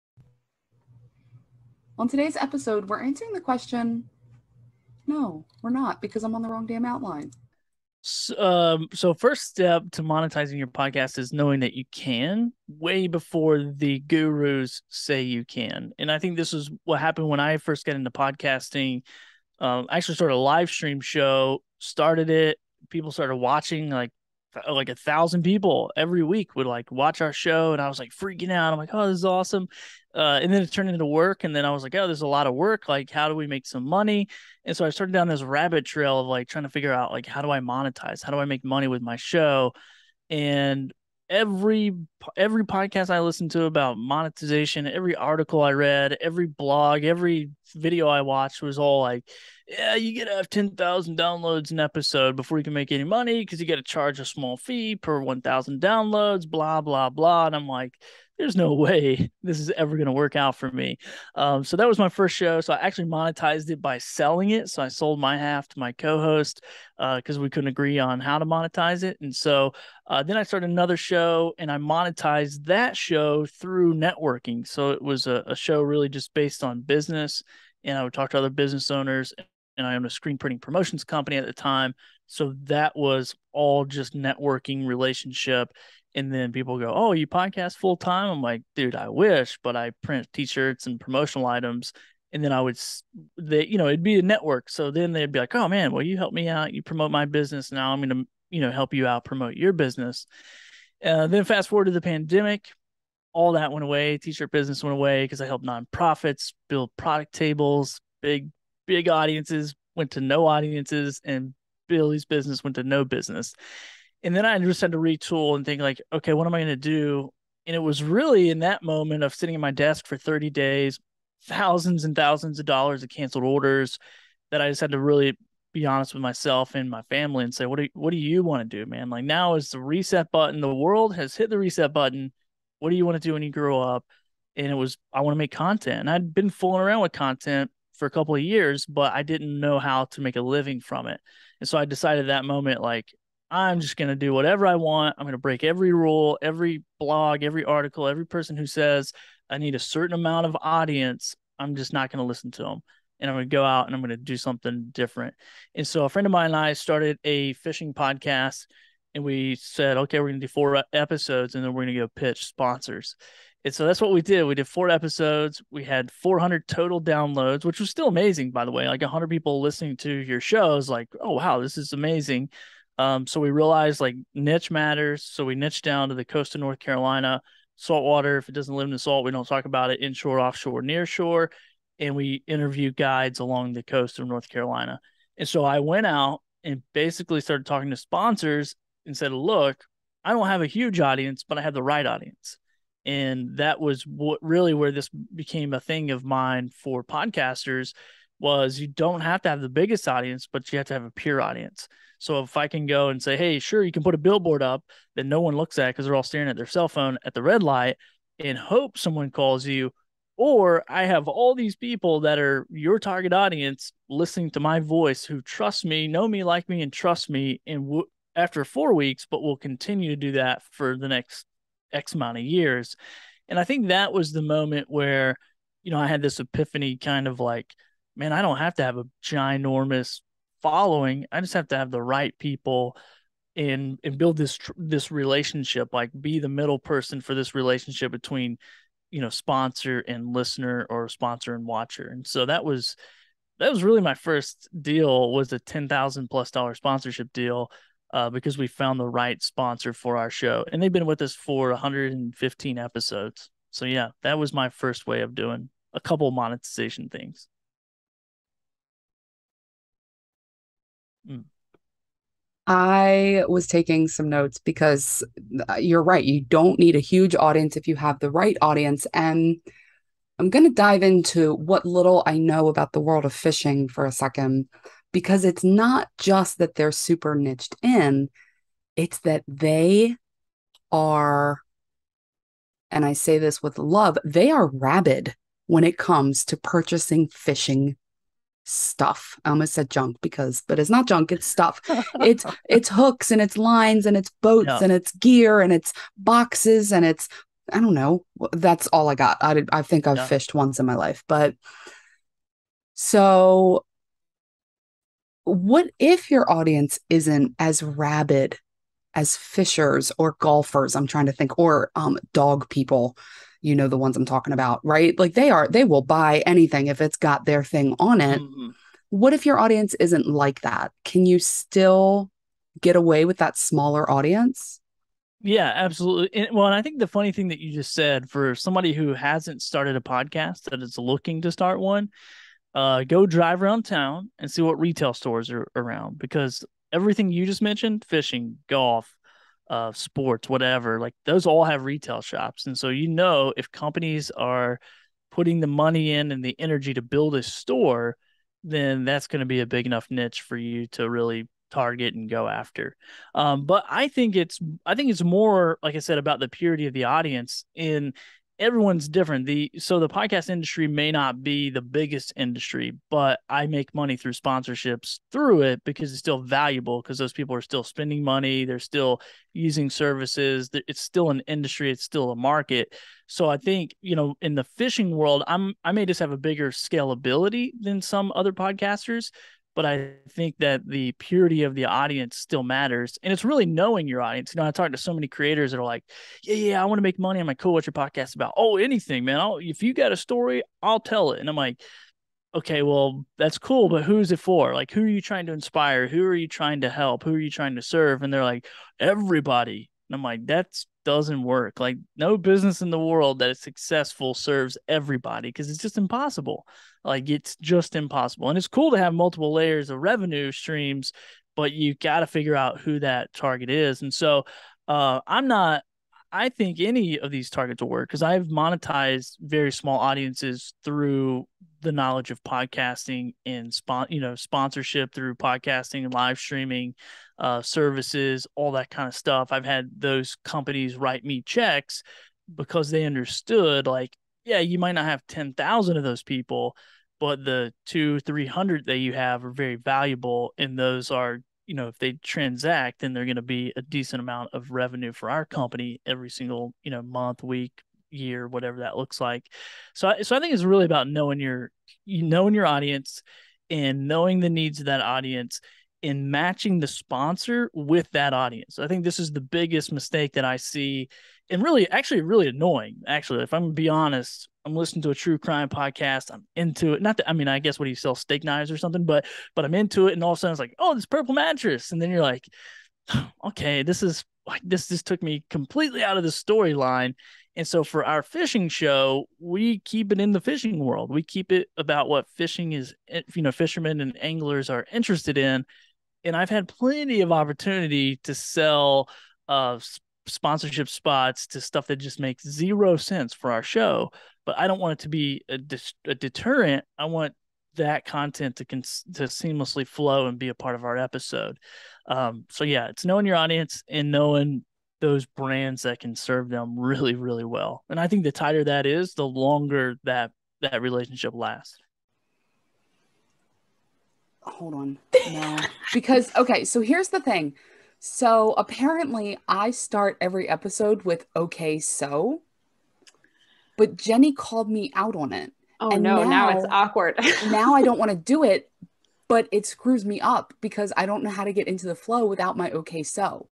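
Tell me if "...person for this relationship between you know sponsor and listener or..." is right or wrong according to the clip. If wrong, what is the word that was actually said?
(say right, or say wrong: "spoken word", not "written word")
right.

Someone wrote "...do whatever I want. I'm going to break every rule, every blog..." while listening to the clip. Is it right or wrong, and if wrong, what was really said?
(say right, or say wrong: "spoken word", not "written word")
right.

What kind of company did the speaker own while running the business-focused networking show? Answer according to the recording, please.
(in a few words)
screen printing promotions company.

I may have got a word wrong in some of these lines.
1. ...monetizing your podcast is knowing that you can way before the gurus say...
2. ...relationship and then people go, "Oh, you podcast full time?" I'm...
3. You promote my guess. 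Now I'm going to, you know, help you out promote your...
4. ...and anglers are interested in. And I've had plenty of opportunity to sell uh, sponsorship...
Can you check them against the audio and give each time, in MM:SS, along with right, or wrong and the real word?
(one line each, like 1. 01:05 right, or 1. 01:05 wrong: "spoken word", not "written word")
1. 00:10 right
2. 01:24 right
3. 01:36 wrong: "business", not "guess"
4. 08:03 right.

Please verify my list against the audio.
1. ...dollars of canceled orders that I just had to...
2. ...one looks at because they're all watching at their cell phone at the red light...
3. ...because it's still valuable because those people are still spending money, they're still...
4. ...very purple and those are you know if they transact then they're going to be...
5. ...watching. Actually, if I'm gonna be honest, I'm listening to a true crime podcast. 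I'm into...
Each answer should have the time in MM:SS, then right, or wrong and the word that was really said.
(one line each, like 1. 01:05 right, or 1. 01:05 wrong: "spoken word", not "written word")
1. 02:02 right
2. 03:25 wrong: "staring", not "watching"
3. 06:05 right
4. 07:19 wrong: "valuable", not "purple"
5. 07:42 wrong: "annoying", not "watching".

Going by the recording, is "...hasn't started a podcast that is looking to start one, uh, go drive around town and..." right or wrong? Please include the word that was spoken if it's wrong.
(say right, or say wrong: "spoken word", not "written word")
right.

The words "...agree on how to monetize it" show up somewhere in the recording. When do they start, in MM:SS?
01:07.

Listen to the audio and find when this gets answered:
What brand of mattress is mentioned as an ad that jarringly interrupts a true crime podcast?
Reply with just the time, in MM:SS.
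07:51.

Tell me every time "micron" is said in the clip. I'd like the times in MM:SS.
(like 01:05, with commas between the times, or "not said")
not said.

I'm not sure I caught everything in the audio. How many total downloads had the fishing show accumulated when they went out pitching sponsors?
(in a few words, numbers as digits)
400.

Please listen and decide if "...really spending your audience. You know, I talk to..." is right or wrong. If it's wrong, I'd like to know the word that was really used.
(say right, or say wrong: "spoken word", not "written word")
wrong: "knowing", not "spending".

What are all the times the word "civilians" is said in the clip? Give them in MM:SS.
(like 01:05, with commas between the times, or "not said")
not said.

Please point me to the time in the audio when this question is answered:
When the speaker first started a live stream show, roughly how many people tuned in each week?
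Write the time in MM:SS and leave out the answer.
00:24.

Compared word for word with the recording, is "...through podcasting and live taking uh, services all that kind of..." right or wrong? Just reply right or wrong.
wrong.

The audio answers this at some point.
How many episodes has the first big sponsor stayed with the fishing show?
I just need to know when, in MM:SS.
04:11.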